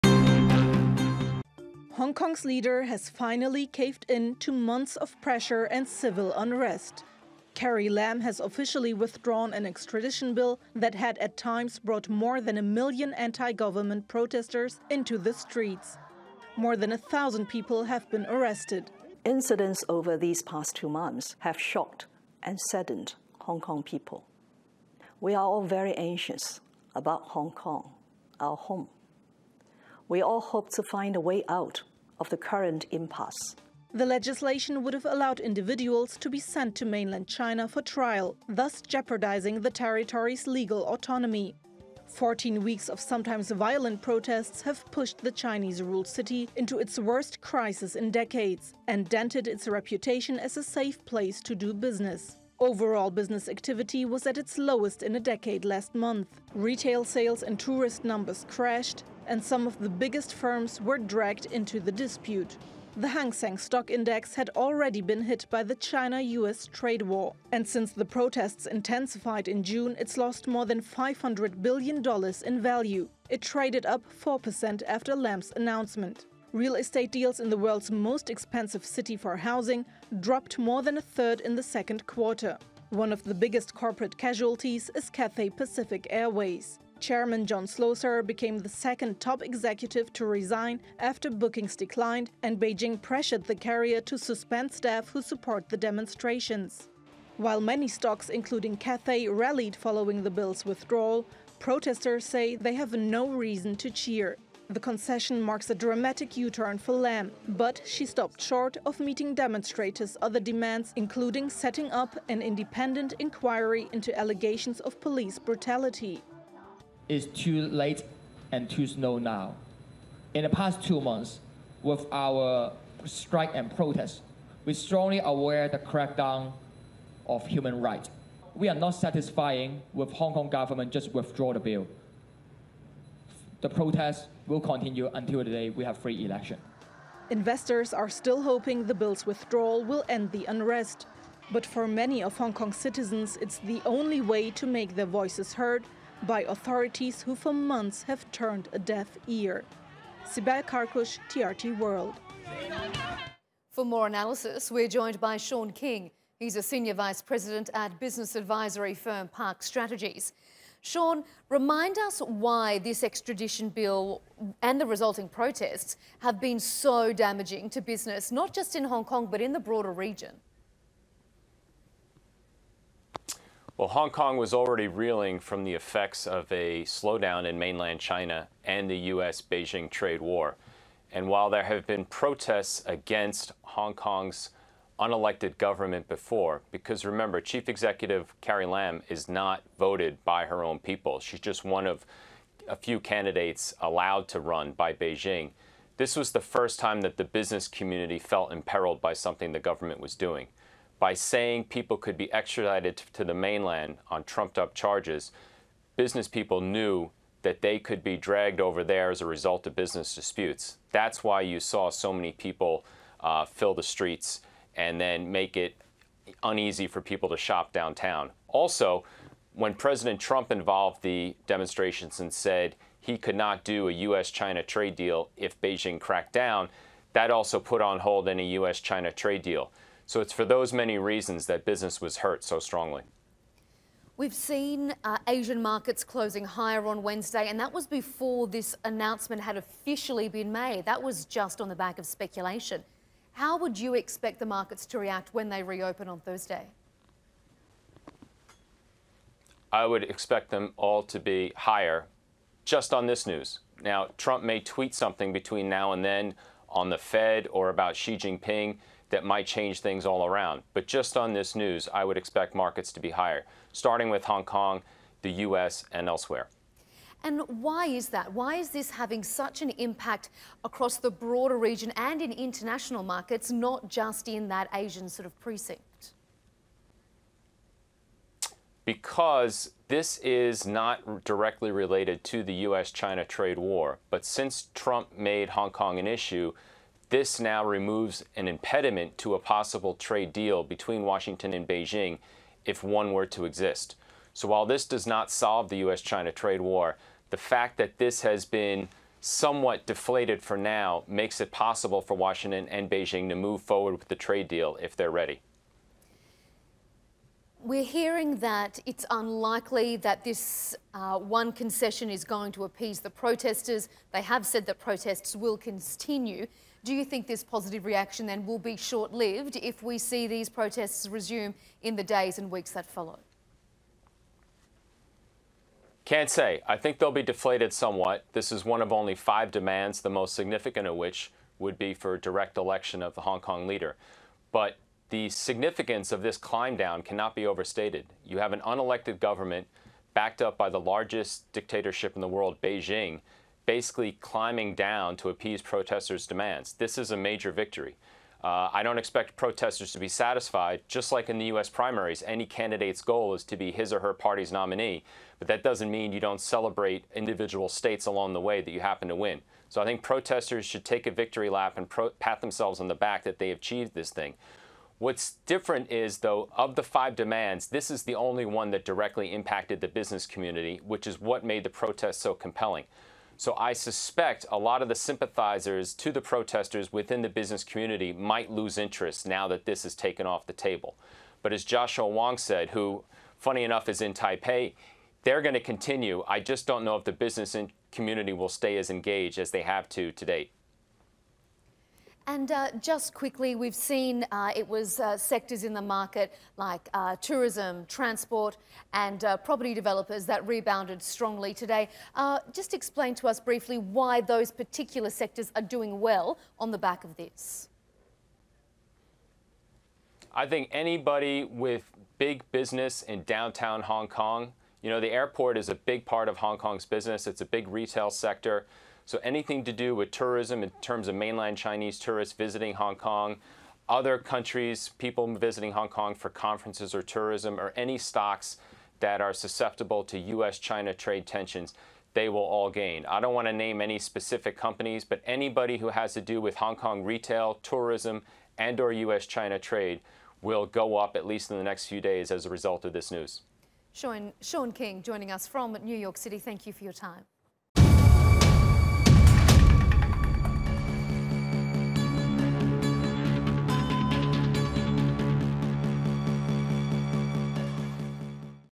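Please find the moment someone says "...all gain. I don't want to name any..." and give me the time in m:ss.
7:12.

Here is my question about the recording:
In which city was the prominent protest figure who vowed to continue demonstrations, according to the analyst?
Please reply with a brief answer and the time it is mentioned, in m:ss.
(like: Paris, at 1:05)
Taipei, at 6:24.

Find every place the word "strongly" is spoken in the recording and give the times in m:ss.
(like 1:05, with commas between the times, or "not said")
2:04, 3:52, 6:41.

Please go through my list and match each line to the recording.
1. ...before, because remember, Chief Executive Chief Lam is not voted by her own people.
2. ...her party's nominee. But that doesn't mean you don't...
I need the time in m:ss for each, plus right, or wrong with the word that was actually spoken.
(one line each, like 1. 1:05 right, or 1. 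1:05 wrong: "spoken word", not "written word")
1. 3:06 wrong: "Carrie", not "Chief"
2. 5:53 right.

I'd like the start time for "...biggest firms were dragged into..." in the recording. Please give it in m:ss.
0:59.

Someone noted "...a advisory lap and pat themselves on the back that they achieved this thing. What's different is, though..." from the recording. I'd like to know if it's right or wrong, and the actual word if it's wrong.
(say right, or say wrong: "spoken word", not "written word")
wrong: "victory", not "advisory".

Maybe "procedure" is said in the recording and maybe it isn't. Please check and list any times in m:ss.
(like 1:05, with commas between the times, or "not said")
not said.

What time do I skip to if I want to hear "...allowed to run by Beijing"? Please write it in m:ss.
3:13.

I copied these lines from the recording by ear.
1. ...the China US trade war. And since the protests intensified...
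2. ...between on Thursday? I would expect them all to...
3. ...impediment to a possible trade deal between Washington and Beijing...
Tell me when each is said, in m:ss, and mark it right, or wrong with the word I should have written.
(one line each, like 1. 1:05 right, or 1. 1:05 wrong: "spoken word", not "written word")
1. 1:05 right
2. 4:05 wrong: "reopen", not "between"
3. 4:48 right.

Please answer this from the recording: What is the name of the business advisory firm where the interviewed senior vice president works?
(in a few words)
Park Strategies.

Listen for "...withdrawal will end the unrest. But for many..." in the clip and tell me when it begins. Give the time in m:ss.
2:19.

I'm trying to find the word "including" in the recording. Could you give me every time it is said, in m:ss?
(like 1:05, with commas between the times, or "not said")
1:38, 1:50.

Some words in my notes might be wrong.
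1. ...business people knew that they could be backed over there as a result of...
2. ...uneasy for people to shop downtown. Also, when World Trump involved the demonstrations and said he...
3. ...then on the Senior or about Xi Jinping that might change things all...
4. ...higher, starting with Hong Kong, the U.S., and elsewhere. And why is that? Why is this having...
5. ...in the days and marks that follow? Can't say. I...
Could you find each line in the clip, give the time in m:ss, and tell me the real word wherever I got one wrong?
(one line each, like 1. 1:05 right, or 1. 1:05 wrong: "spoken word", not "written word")
1. 3:25 wrong: "dragged", not "backed"
2. 3:36 wrong: "President", not "World"
3. 4:16 wrong: "Fed", not "Senior"
4. 4:23 right
5. 5:21 wrong: "weeks", not "marks".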